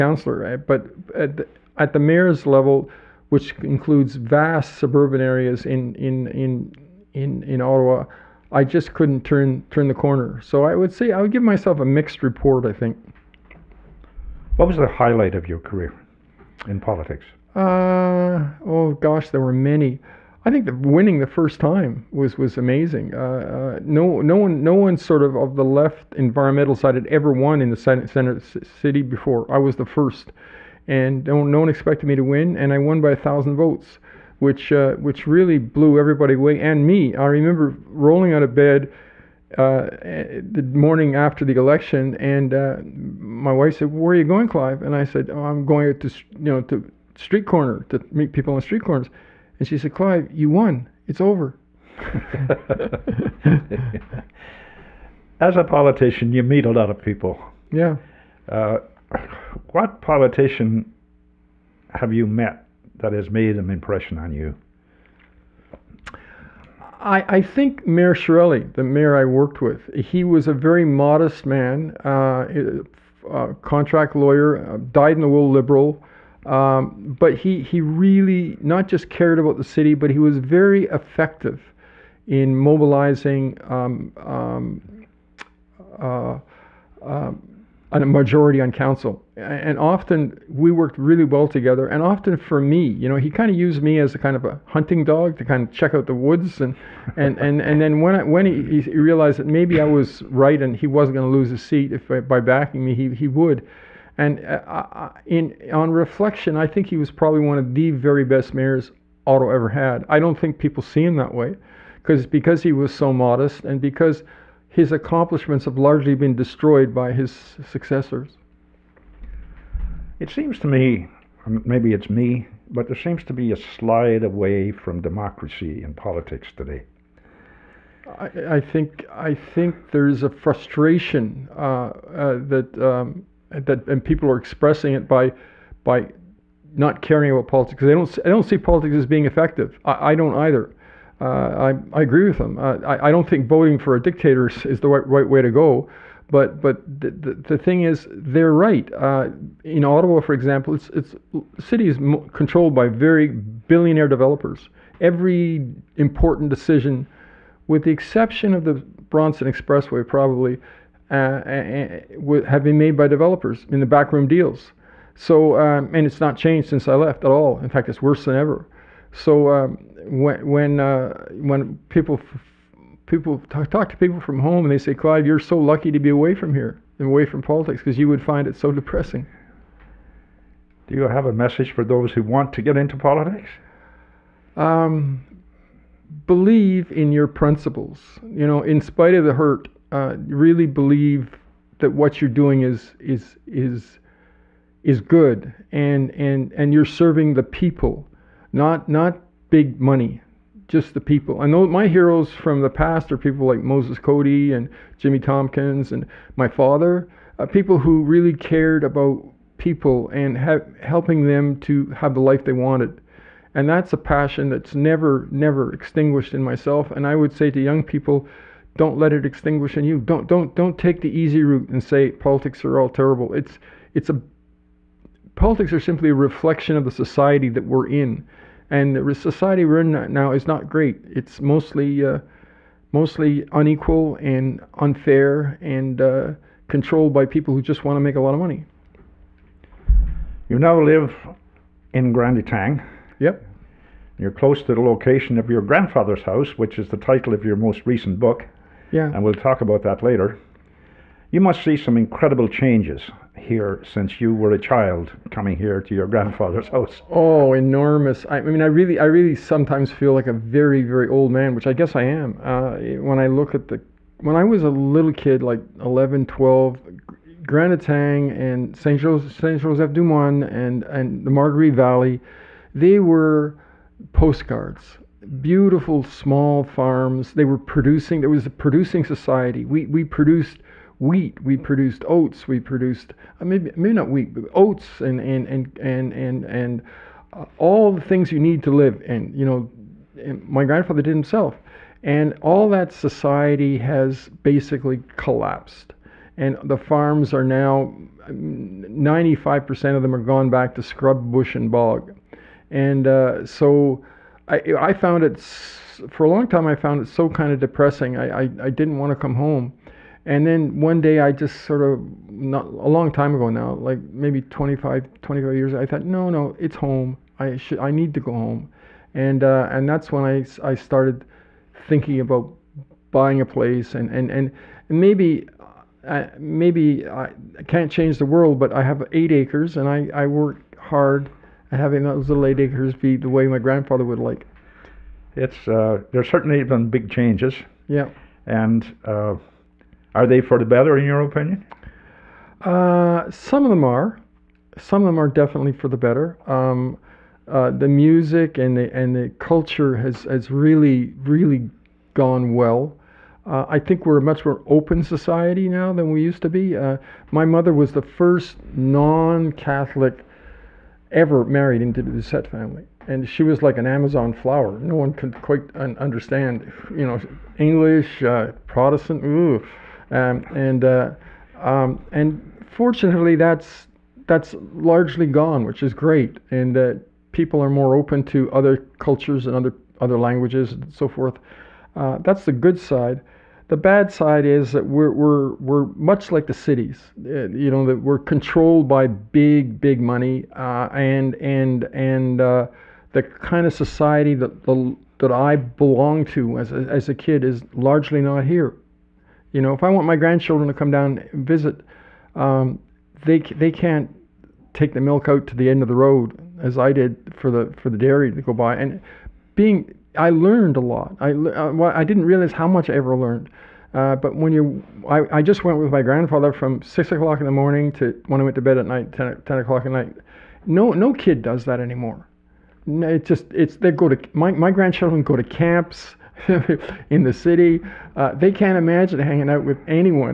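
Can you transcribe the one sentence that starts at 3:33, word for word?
And that's a passion that's never, never extinguished in myself.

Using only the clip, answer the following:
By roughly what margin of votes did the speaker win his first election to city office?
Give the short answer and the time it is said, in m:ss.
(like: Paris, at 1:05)
1000 votes, at 0:33.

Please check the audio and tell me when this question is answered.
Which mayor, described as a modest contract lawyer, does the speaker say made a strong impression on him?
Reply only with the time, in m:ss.
1:07.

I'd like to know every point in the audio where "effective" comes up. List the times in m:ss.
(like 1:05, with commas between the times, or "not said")
1:20, 2:19.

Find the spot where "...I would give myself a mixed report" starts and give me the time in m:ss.
0:11.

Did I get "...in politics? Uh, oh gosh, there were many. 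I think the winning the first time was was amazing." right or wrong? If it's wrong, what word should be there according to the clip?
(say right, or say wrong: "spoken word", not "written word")
right.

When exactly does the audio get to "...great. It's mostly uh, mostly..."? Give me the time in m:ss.
3:50.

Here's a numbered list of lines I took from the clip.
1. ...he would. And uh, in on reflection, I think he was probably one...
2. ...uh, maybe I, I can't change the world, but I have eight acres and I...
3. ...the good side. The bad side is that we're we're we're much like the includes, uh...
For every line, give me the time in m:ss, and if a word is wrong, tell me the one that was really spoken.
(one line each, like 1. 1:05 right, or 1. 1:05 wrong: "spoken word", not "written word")
1. 1:43 right
2. 5:26 right
3. 6:22 wrong: "cities", not "includes".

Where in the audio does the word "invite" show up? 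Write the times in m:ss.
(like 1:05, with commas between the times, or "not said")
not said.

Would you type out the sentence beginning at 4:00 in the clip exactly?
You now live in Grand Étang.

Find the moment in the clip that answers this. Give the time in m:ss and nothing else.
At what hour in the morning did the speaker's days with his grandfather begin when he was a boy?
6:56.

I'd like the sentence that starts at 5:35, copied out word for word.
It's uh, there's certainly been big changes.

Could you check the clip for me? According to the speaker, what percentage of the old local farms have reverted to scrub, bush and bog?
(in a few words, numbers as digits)
95%.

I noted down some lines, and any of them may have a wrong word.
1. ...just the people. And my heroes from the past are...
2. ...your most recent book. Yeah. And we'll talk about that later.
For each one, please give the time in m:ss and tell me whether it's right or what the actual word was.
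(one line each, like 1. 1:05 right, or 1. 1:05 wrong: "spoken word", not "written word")
1. 3:20 right
2. 4:07 right.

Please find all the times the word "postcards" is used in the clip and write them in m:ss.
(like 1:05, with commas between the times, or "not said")
4:34.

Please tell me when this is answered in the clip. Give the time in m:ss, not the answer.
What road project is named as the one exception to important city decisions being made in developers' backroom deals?
2:39.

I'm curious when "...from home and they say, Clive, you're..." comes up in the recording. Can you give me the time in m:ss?
2:54.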